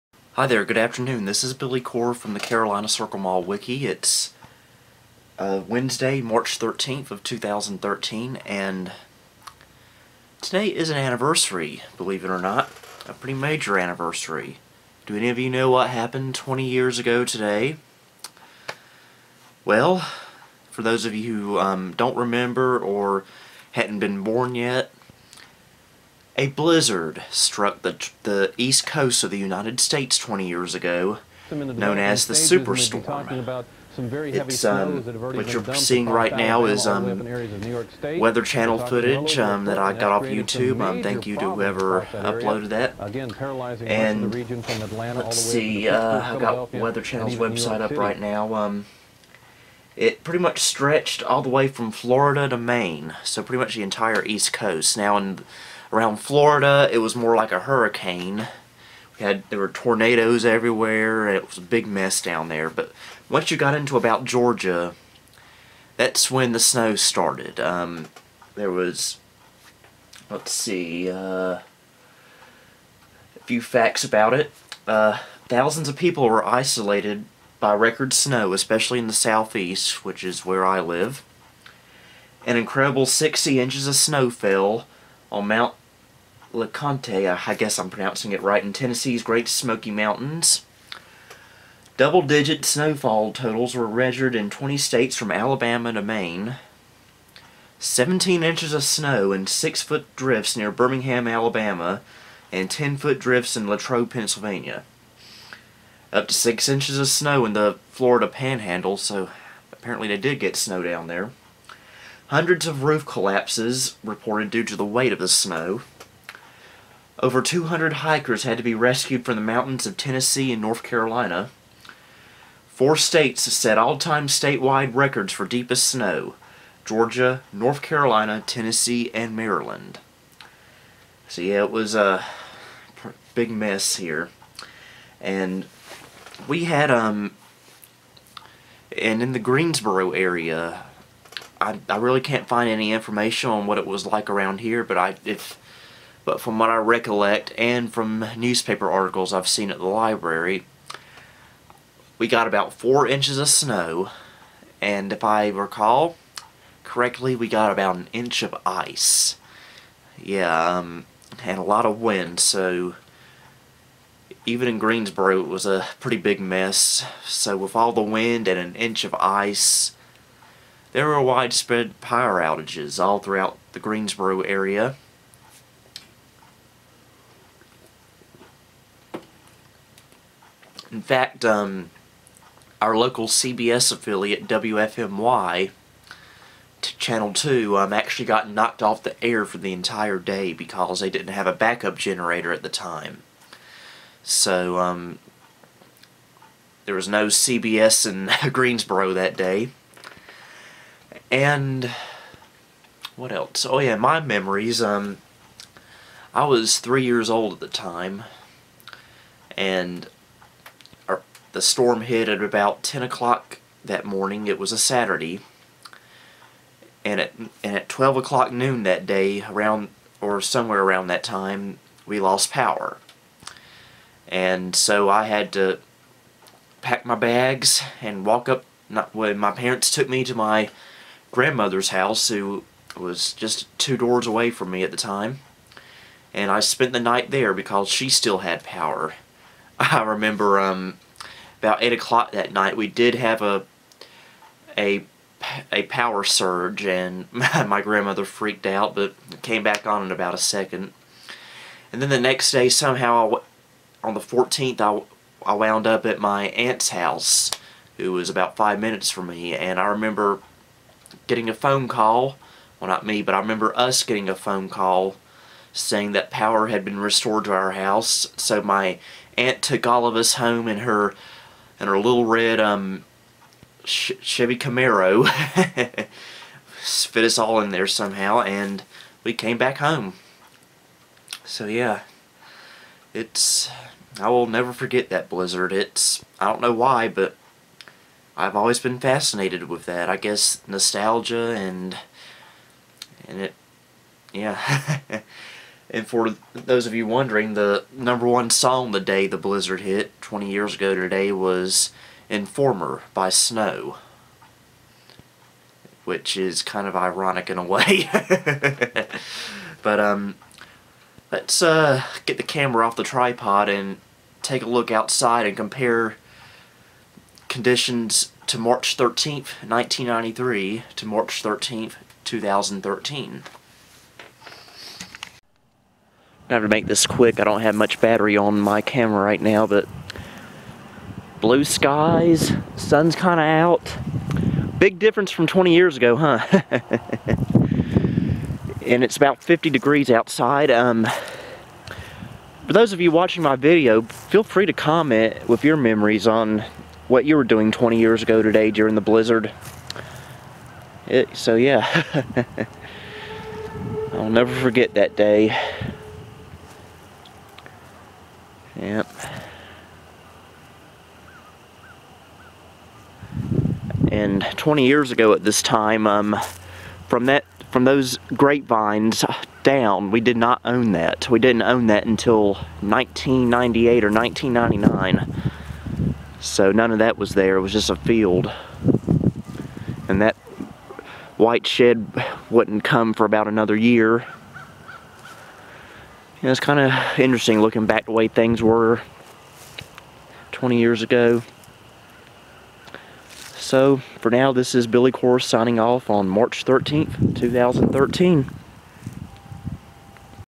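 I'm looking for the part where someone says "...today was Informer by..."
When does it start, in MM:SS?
05:00.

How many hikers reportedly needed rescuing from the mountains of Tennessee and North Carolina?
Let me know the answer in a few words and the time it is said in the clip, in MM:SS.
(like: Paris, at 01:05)
200, at 01:57.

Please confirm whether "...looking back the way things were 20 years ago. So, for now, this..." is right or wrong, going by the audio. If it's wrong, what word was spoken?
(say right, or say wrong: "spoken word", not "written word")
right.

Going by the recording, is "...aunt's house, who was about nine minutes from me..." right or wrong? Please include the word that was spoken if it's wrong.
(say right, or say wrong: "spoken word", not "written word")
wrong: "five", not "nine".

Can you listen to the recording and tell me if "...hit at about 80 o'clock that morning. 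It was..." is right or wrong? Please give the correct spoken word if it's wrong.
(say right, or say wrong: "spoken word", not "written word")
wrong: "10", not "80".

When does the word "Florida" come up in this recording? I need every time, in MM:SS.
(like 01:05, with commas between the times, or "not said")
00:51, 00:56, 01:47.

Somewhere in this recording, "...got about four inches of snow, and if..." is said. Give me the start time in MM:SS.
02:32.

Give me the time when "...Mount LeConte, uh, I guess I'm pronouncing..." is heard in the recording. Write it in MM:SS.
01:25.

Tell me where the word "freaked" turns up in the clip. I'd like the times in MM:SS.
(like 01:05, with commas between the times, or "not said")
04:08.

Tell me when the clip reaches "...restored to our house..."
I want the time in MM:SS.
04:26.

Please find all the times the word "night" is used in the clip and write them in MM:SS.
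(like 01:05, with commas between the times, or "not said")
03:57, 04:02.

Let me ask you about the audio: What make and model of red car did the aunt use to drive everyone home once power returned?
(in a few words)
Chevy Camaro.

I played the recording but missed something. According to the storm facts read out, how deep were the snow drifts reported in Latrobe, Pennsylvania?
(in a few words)
10-foot.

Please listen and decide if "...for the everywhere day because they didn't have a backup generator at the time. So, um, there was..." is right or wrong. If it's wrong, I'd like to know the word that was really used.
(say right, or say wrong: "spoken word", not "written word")
wrong: "entire", not "everywhere".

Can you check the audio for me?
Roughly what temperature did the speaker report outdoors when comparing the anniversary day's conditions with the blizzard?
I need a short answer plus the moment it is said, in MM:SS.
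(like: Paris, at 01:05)
50 degrees, at 05:39.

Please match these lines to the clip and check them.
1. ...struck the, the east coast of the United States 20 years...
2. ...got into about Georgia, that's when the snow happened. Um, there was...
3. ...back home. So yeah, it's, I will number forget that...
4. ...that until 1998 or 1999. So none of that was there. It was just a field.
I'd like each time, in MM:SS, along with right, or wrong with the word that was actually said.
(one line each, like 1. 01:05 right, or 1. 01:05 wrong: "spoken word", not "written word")
1. 00:27 right
2. 01:03 wrong: "started", not "happened"
3. 04:39 wrong: "never", not "number"
4. 06:11 right.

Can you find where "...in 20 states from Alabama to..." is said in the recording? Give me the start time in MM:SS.
01:34.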